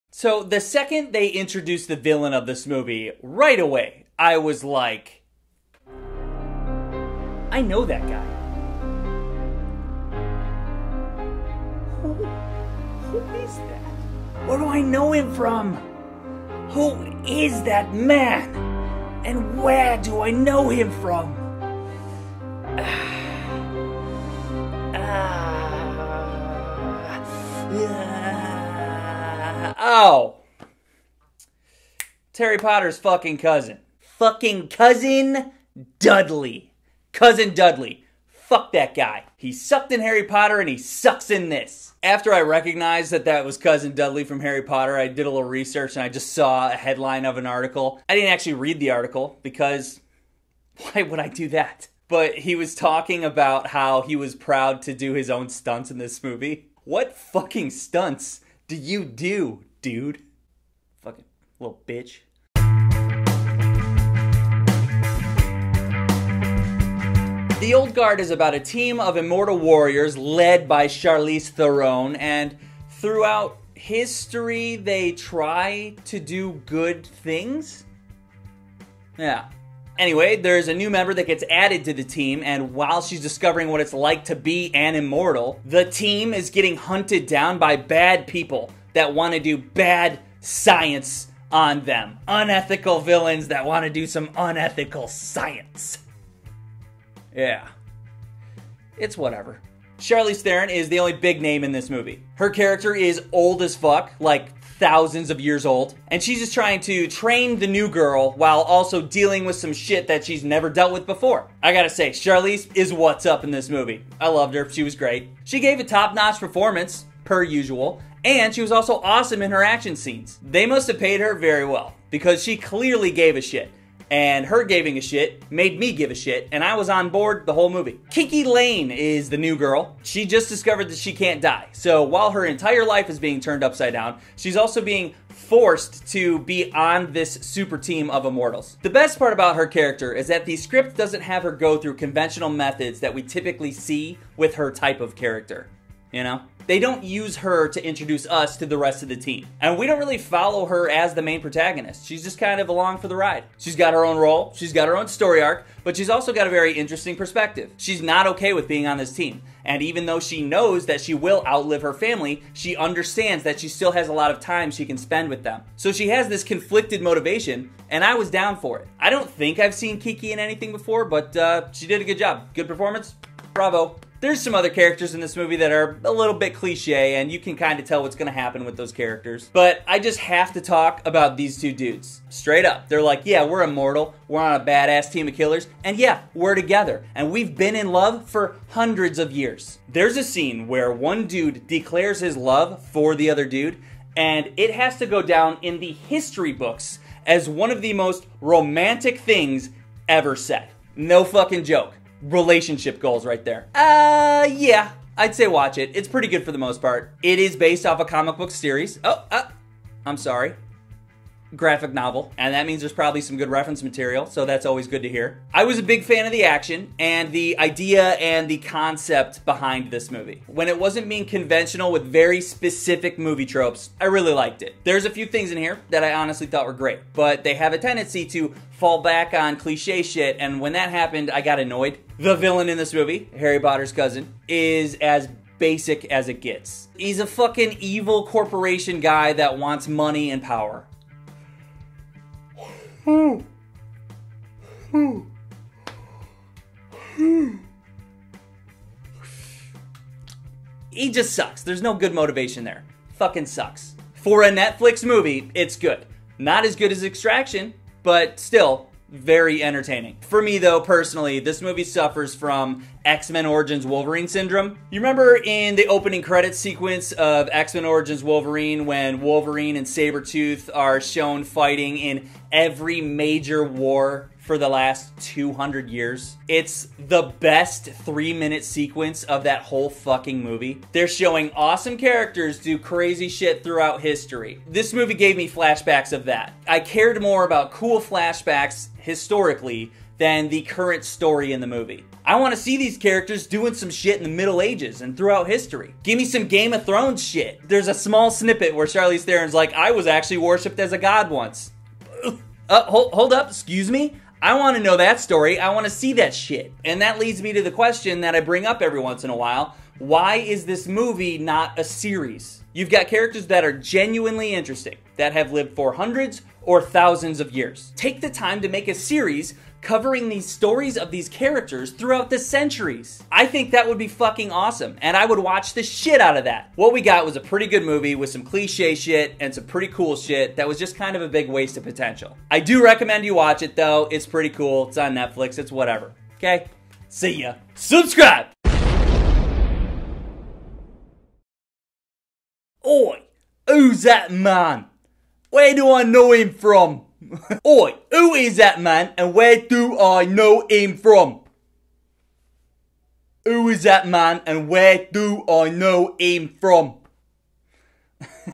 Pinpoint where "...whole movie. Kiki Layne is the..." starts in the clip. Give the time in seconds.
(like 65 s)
127 s.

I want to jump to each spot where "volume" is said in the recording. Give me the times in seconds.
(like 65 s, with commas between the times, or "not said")
not said.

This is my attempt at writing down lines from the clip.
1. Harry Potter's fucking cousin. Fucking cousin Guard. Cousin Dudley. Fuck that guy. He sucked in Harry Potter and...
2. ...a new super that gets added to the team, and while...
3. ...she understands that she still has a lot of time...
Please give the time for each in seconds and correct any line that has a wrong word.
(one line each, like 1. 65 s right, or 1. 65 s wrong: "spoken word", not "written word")
1. 32 s wrong: "Dudley", not "Guard"
2. 80 s wrong: "member", not "super"
3. 162 s right.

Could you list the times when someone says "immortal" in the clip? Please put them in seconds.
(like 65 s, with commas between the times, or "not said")
69 s, 84 s, 138 s, 183 s.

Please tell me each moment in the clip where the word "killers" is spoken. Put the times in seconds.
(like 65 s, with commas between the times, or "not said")
185 s.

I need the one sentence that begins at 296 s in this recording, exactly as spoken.
Give me some Game of Thrones shit.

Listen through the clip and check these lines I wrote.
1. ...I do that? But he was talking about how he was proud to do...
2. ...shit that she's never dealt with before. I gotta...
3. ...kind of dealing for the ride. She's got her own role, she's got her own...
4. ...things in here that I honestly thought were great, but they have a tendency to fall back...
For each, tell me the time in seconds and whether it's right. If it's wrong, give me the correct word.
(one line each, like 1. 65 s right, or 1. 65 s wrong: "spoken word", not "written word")
1. 51 s right
2. 109 s right
3. 152 s wrong: "along", not "dealing"
4. 225 s right.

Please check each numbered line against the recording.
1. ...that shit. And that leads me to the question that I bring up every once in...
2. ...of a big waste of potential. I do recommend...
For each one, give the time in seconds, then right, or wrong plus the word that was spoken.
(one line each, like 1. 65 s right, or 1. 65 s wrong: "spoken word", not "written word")
1. 306 s right
2. 331 s right.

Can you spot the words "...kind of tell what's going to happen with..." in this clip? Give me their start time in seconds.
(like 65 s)
177 s.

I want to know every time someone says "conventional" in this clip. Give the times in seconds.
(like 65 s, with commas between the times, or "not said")
141 s, 221 s.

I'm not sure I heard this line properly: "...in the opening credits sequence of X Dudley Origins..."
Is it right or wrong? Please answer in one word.
wrong.